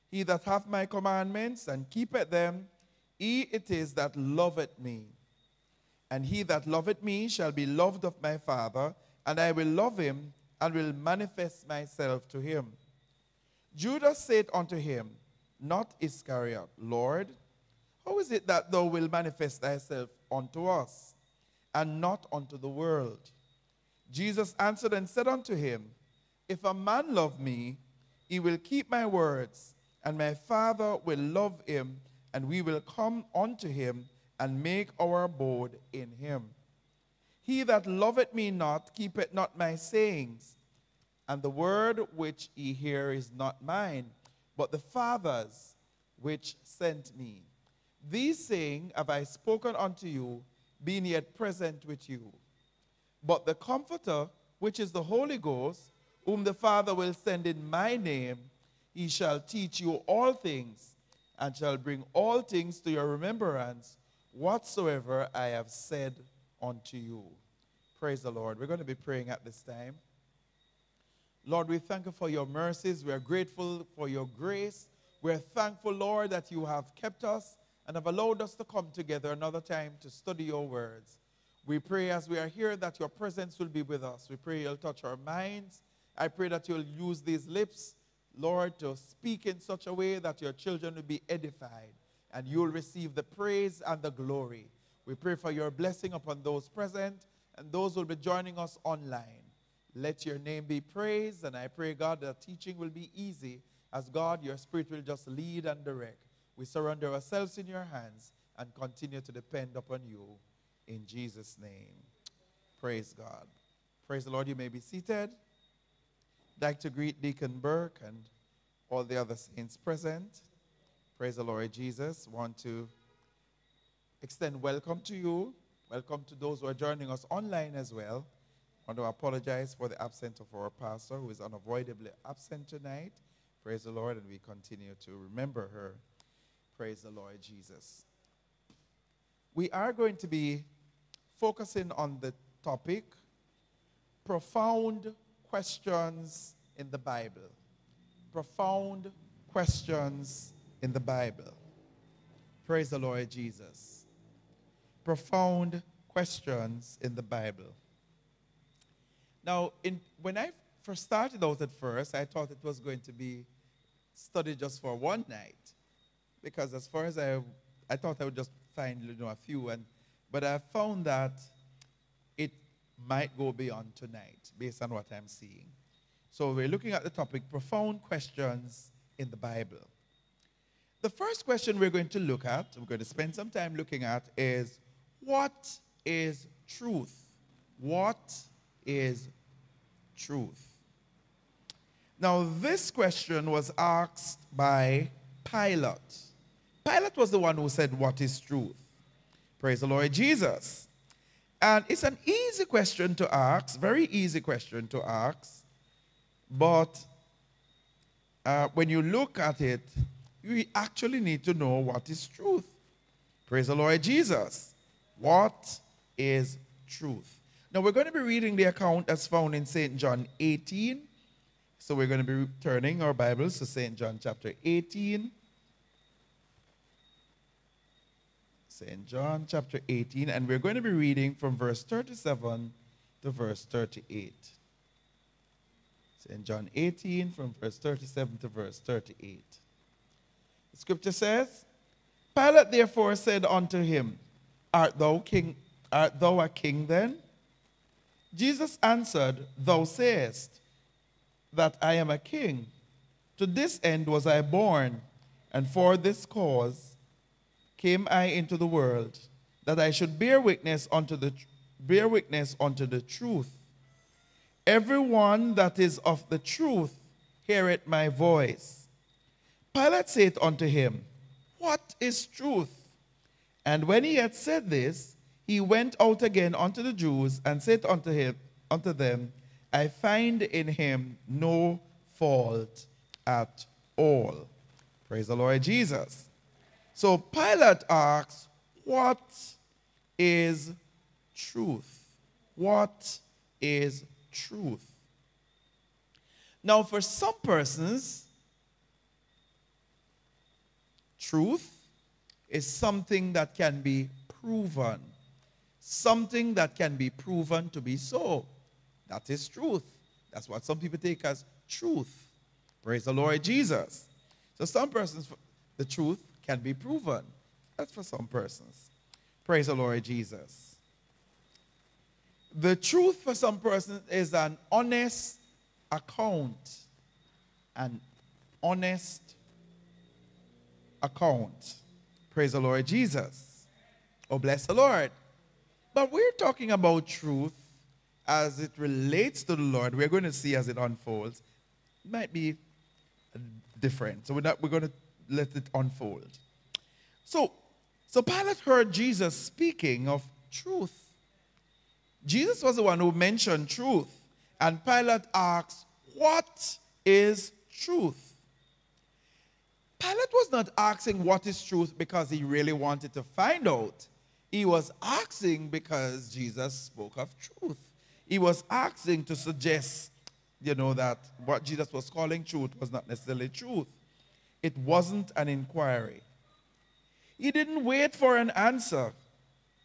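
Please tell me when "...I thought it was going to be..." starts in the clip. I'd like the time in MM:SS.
02:42.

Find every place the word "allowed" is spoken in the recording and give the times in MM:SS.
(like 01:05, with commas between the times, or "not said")
01:18.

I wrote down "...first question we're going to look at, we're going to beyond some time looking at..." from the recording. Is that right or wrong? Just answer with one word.
wrong.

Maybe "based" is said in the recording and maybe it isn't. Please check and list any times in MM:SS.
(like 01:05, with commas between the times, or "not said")
02:54.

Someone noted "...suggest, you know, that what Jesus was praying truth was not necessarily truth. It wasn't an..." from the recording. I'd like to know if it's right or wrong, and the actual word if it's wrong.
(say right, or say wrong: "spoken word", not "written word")
wrong: "calling", not "praying".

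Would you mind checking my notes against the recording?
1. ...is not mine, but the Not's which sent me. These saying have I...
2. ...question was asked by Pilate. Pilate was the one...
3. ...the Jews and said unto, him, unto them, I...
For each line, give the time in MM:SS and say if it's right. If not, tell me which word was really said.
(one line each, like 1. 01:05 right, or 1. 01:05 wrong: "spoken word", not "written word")
1. 00:43 wrong: "Father", not "Not"
2. 03:12 right
3. 04:36 right.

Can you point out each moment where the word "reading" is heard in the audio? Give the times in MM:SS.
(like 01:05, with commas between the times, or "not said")
03:38, 03:50.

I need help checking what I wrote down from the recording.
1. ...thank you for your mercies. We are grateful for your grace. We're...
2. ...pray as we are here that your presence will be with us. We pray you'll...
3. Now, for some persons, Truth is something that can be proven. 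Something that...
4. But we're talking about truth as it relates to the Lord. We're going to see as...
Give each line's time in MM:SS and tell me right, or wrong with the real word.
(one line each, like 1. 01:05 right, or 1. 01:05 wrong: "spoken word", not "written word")
1. 01:11 right
2. 01:21 right
3. 04:56 right
4. 05:35 right.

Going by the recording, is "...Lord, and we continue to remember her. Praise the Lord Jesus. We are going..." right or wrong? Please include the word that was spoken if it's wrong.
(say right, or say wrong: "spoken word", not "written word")
right.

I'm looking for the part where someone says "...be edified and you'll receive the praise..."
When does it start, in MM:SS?
01:31.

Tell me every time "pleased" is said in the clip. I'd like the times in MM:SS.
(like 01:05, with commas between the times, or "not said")
not said.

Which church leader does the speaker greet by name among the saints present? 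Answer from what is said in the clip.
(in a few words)
Deacon Burke.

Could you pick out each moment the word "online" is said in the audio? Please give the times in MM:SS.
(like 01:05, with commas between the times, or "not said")
01:38, 02:07.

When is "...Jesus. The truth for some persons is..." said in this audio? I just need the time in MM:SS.
05:20.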